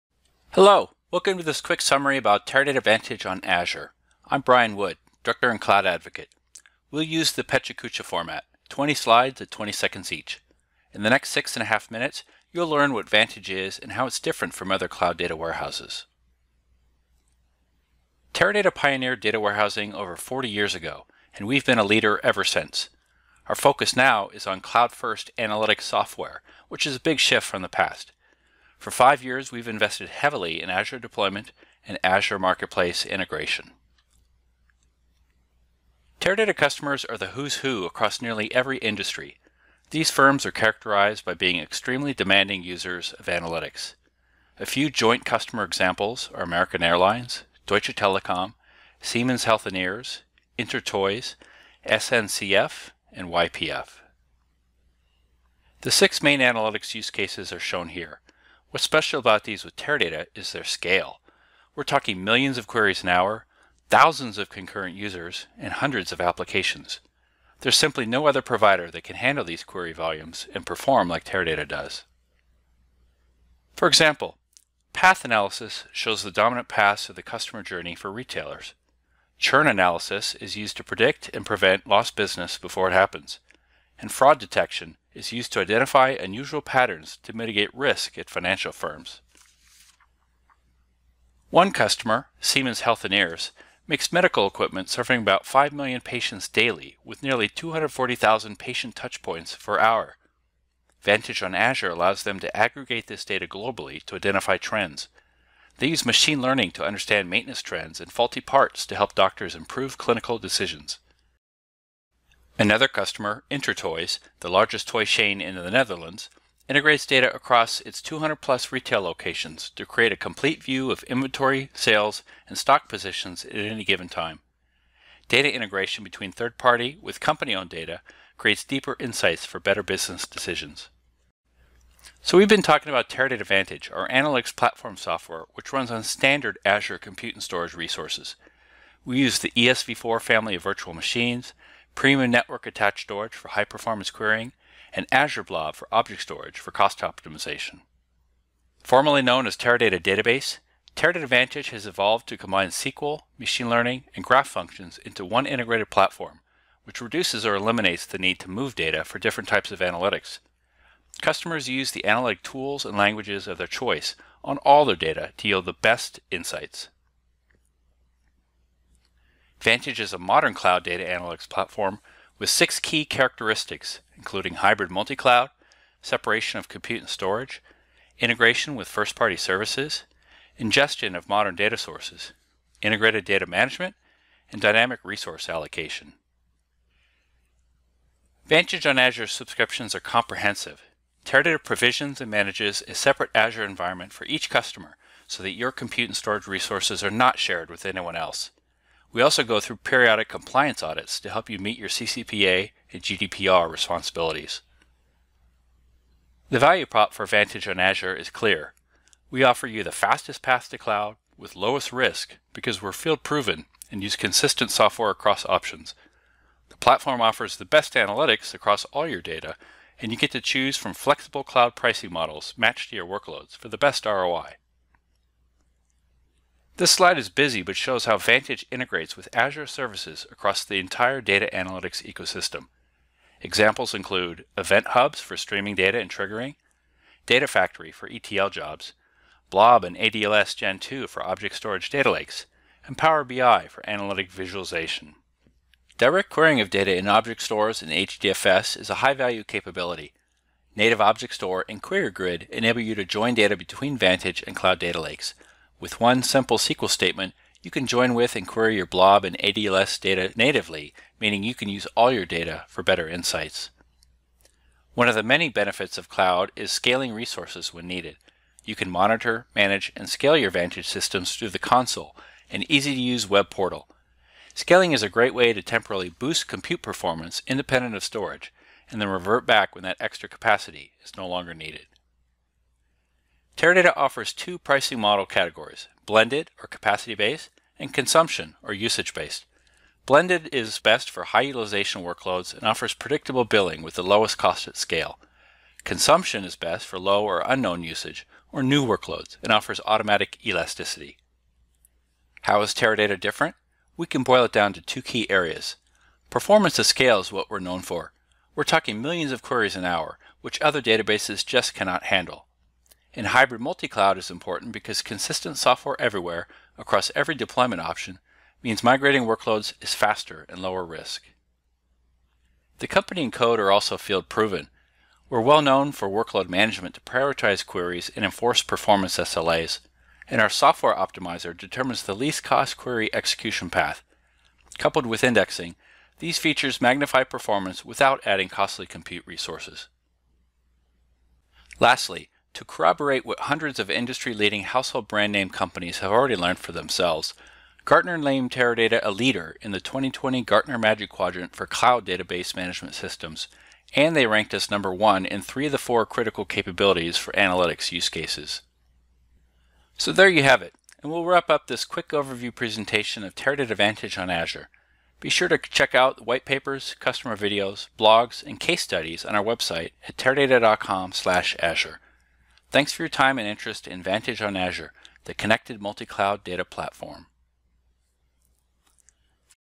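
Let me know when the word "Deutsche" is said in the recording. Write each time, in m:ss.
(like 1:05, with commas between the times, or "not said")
0:47.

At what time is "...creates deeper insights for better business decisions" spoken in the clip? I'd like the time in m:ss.
2:08.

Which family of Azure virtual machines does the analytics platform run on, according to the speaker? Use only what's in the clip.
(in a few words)
ESV4.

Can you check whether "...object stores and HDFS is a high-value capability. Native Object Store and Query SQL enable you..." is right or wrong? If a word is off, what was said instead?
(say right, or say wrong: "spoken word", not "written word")
wrong: "Grid", not "SQL".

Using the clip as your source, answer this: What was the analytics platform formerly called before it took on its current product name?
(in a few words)
Teradata Database.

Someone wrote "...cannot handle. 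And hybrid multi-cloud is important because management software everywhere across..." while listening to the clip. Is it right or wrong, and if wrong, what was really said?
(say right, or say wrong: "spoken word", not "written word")
wrong: "consistent", not "management".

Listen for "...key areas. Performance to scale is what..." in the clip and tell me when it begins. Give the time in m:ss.
5:05.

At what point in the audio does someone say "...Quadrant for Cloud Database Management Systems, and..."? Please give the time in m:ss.
5:51.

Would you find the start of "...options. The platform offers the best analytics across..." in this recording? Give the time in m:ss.
3:35.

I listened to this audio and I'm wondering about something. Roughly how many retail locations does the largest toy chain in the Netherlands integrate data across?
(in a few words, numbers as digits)
200 plus.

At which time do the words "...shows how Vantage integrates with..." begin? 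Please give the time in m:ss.
3:47.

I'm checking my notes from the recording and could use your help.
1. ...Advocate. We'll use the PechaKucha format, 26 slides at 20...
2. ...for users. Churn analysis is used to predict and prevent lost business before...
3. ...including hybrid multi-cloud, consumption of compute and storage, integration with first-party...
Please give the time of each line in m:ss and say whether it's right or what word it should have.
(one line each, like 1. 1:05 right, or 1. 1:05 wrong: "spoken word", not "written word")
1. 0:05 wrong: "20", not "26"
2. 1:17 wrong: "retailers", not "users"
3. 2:54 wrong: "separation", not "consumption".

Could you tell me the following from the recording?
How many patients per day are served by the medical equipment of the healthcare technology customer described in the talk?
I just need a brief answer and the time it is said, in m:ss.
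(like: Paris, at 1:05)
5 million, at 1:35.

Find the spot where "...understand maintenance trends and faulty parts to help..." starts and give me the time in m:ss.
1:46.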